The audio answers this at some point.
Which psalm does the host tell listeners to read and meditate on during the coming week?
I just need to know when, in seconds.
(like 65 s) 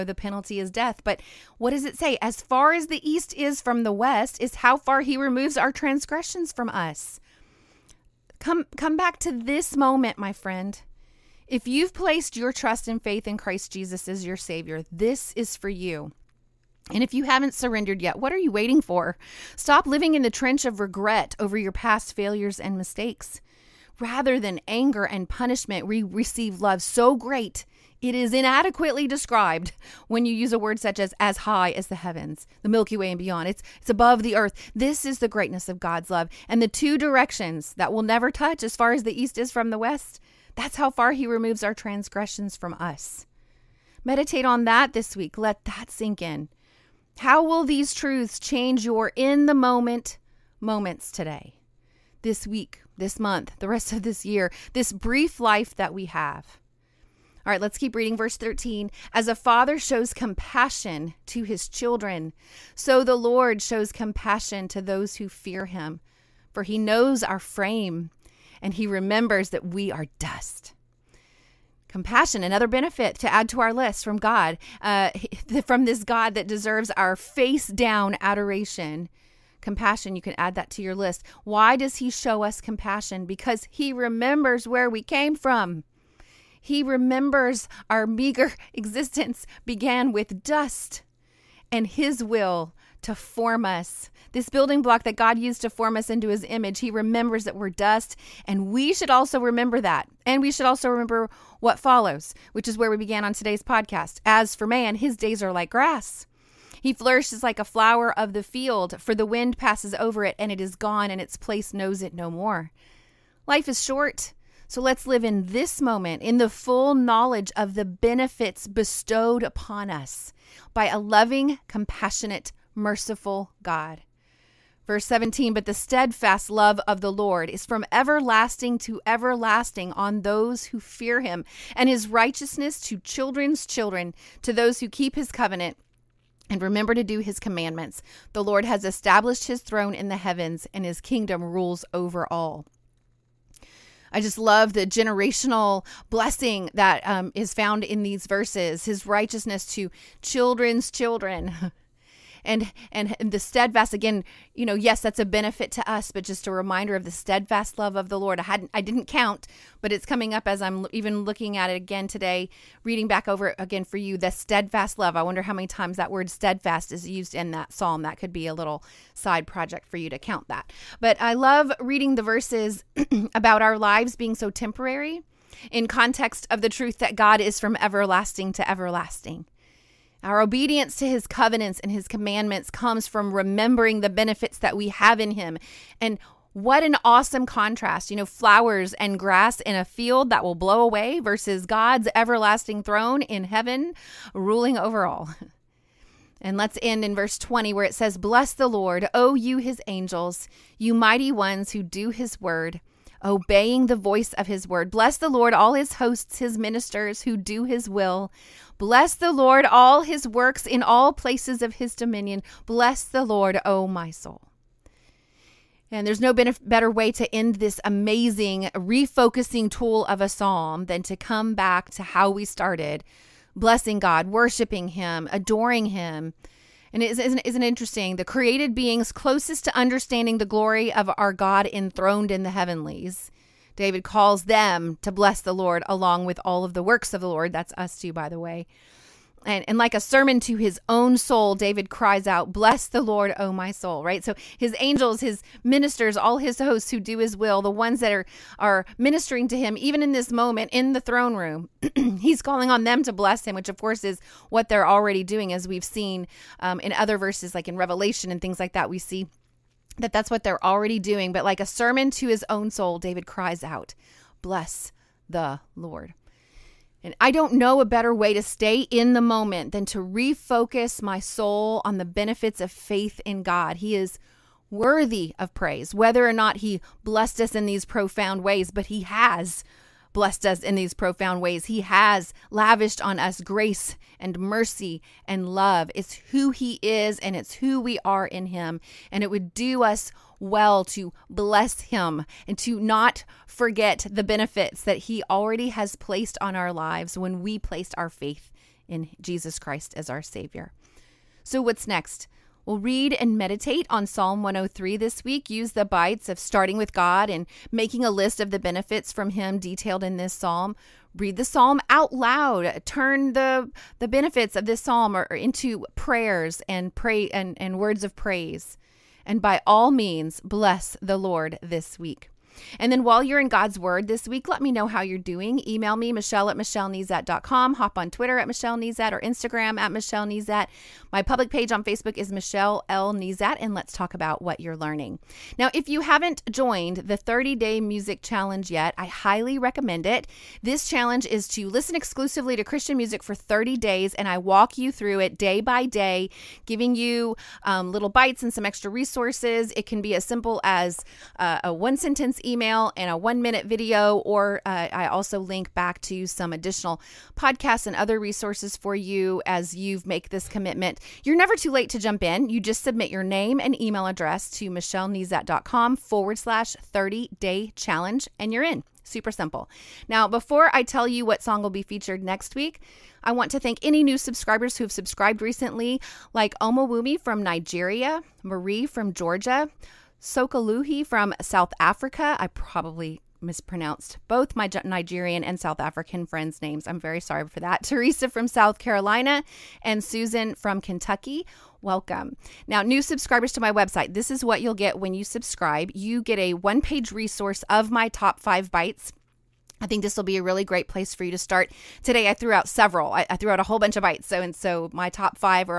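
304 s.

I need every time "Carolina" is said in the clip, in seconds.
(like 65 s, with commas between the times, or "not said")
388 s.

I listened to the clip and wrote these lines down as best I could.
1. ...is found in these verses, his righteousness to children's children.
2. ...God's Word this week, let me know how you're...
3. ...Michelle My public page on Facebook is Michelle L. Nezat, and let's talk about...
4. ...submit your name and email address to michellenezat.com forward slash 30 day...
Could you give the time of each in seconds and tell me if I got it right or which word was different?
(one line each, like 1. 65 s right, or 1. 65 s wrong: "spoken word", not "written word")
1. 147 s right
2. 323 s right
3. 329 s right
4. 362 s right.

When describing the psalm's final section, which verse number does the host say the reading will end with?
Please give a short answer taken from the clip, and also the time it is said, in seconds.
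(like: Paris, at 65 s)
20, at 197 s.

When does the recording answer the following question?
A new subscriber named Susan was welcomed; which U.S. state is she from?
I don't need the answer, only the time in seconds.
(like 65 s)
390 s.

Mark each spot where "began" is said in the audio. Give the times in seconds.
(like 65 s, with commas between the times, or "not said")
89 s, 102 s.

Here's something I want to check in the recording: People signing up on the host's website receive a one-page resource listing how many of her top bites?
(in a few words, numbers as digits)
5.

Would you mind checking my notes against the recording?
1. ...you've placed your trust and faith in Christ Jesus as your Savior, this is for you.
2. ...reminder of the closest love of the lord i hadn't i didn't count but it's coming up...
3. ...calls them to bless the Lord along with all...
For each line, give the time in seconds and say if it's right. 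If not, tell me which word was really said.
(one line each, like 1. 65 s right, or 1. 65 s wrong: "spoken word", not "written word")
1. 11 s right
2. 156 s wrong: "steadfast", not "closest"
3. 234 s right.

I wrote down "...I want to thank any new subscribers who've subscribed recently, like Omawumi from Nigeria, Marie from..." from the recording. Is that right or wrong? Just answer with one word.
right.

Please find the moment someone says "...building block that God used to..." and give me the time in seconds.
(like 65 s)
94 s.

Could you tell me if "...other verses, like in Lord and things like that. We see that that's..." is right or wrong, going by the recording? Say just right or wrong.
wrong.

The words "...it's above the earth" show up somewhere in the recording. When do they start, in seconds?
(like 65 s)
33 s.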